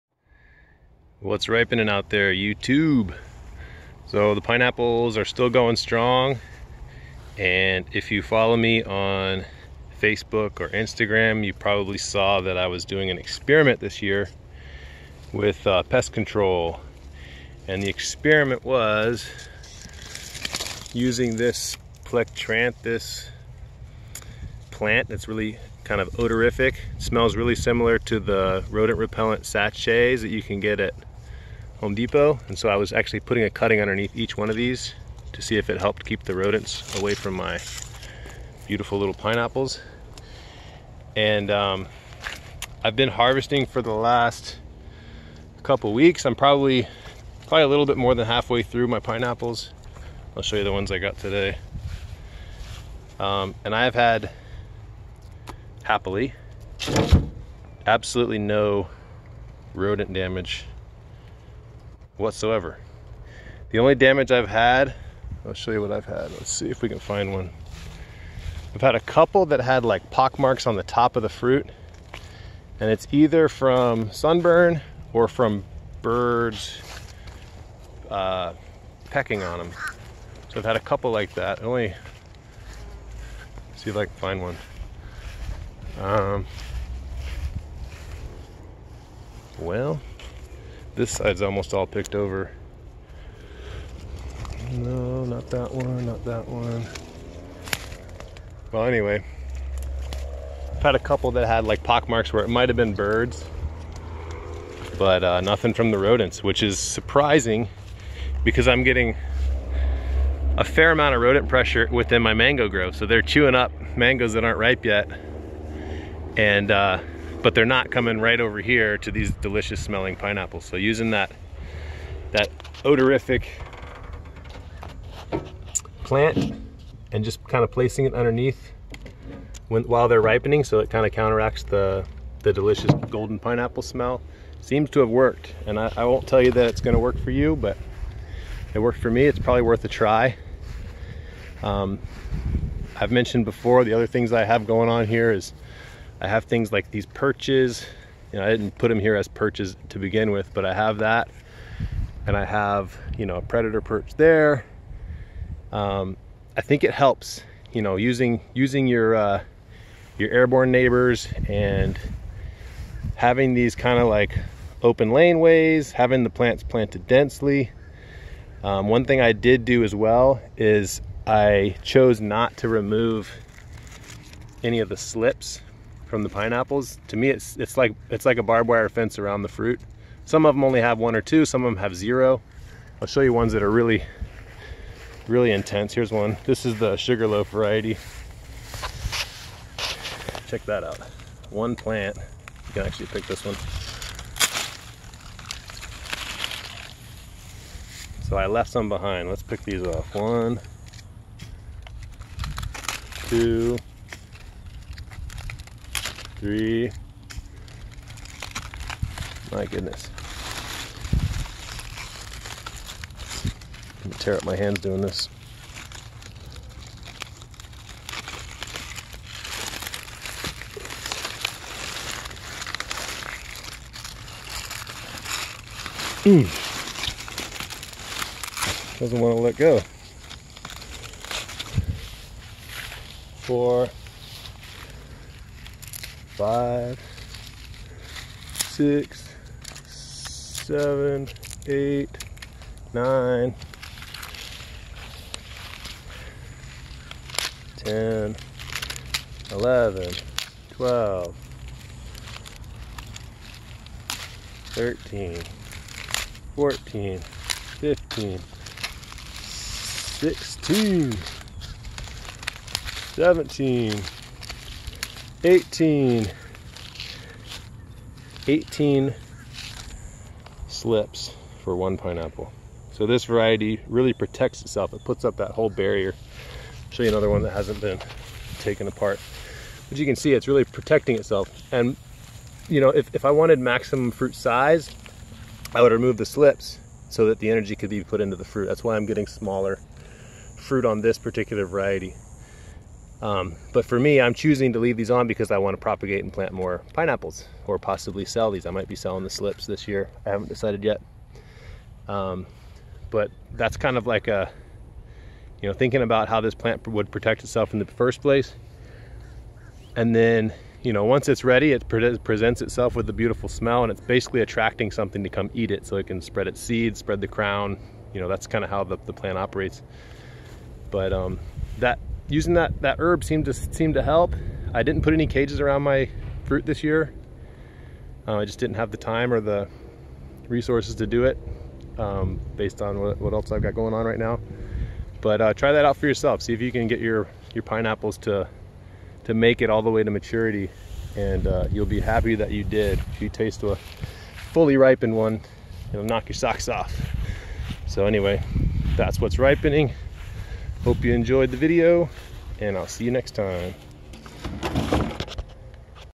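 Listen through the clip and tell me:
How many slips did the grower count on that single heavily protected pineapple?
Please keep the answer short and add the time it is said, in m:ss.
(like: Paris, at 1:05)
18, at 4:28.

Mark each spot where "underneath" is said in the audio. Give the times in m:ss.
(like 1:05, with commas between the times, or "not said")
0:33, 2:08.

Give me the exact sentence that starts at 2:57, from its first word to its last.
To me, it's it's like it's like a barbed wire fence around the fruit.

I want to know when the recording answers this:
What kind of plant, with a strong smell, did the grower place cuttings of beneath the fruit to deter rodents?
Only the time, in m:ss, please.
0:22.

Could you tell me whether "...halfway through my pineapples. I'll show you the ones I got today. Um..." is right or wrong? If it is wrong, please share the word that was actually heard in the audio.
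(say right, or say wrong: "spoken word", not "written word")
right.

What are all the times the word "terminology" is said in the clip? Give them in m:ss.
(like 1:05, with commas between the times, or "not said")
not said.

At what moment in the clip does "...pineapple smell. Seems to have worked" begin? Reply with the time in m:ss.
2:13.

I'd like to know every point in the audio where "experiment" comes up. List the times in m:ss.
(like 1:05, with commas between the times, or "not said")
0:13, 0:17.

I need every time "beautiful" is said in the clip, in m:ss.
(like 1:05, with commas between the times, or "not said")
0:38, 5:13.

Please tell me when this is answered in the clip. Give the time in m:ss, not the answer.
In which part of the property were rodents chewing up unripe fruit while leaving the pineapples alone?
1:52.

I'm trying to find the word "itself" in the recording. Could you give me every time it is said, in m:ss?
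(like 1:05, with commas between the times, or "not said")
4:34, 4:41, 5:07, 5:12.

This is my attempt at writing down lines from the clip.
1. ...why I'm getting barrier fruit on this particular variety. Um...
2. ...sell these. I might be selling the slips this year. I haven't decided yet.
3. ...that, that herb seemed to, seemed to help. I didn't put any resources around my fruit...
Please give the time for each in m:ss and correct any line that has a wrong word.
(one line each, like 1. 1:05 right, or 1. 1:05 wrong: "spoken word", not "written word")
1. 4:48 wrong: "smaller", not "barrier"
2. 4:58 right
3. 5:22 wrong: "cages", not "resources".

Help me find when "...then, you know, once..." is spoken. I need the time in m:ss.
5:10.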